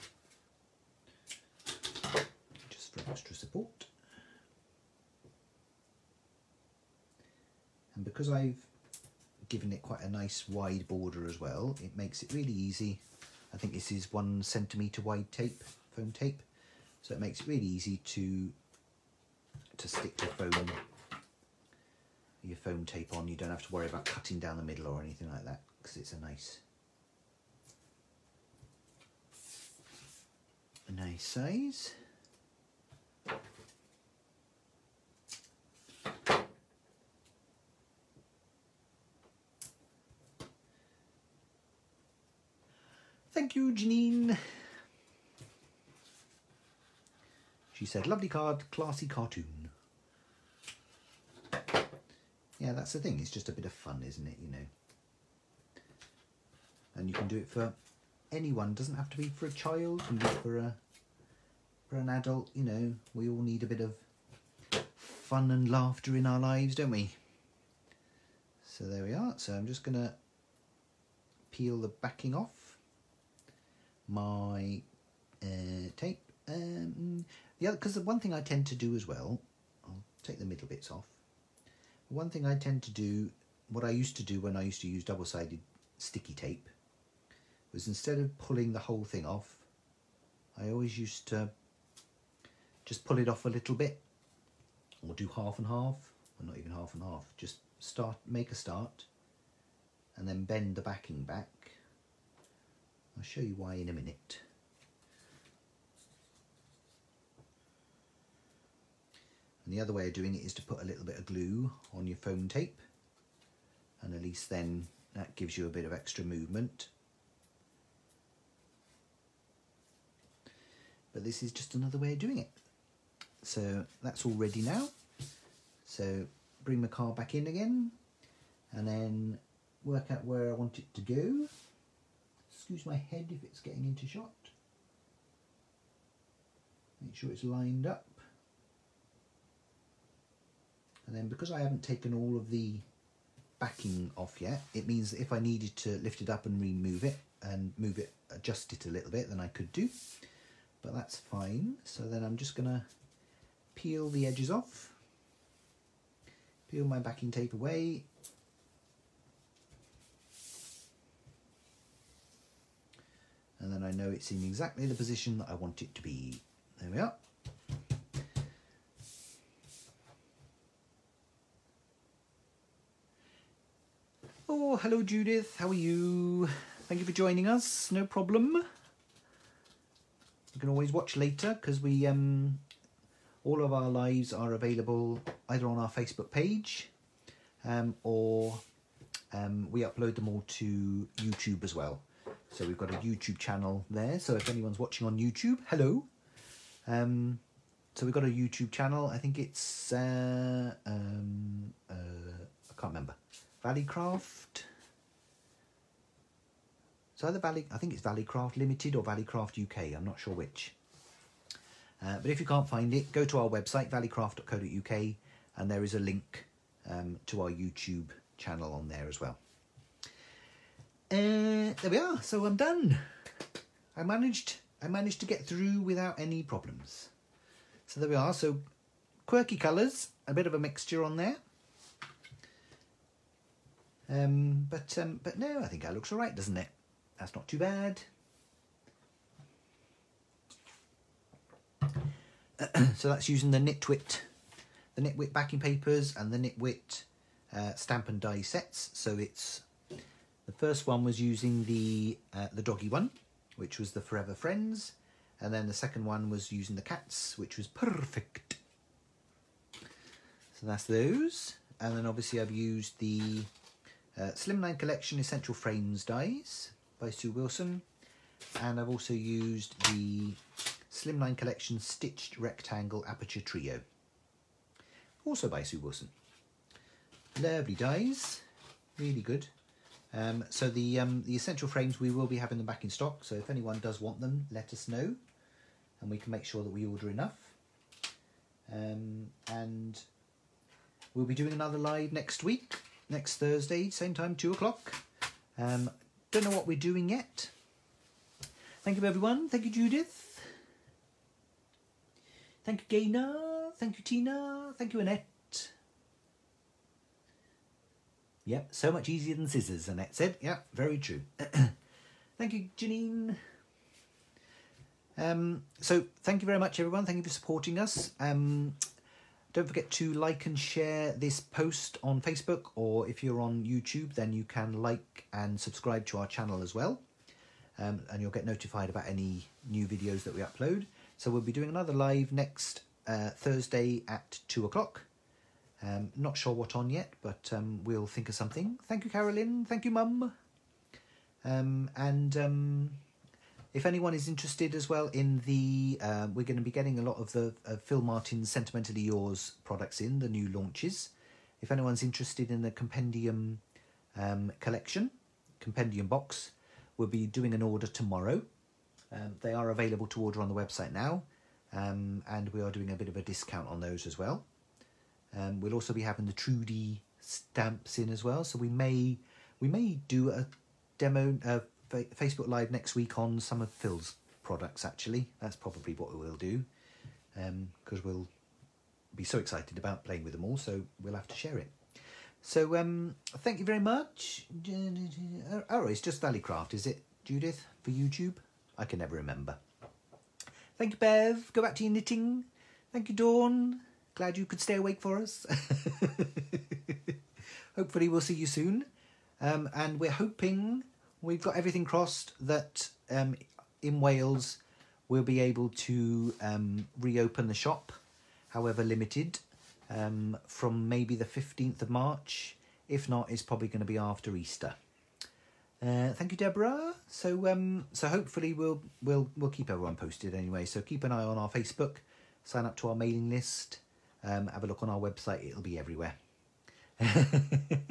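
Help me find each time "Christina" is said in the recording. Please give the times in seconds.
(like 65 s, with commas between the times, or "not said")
not said.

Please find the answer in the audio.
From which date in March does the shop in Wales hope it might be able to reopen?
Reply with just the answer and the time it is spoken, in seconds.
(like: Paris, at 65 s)
15 March, at 411 s.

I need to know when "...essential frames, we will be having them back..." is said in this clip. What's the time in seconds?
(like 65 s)
281 s.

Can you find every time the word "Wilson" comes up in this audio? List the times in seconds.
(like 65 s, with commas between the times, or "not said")
267 s, 275 s.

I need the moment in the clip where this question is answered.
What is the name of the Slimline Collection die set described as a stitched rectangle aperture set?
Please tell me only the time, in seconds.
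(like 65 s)
271 s.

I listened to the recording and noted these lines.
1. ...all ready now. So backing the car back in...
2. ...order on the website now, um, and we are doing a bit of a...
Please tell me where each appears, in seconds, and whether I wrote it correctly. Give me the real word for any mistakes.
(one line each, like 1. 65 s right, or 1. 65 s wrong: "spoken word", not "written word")
1. 124 s wrong: "bring", not "backing"
2. 360 s right.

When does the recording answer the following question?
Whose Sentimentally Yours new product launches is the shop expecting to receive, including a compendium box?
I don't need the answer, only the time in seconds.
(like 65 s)
347 s.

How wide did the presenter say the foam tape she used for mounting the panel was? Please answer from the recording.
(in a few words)
1 centimetre.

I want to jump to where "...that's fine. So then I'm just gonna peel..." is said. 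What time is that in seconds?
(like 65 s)
150 s.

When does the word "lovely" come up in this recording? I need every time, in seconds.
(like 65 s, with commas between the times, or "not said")
48 s, 277 s.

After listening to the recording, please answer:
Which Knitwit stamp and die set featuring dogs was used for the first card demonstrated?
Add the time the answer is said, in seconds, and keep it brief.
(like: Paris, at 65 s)
Forever Friends, at 254 s.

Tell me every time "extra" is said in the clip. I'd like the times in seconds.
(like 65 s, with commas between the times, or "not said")
3 s, 115 s.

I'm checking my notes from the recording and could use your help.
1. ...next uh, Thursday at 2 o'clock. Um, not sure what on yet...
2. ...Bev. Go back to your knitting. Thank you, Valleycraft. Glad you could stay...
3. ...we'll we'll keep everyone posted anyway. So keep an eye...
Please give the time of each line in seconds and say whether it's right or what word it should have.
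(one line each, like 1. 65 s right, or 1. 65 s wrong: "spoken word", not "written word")
1. 332 s right
2. 390 s wrong: "Dawn", not "Valleycraft"
3. 419 s right.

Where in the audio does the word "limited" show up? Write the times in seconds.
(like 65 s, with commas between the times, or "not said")
208 s, 408 s.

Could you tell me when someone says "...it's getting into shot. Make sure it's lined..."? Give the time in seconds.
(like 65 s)
133 s.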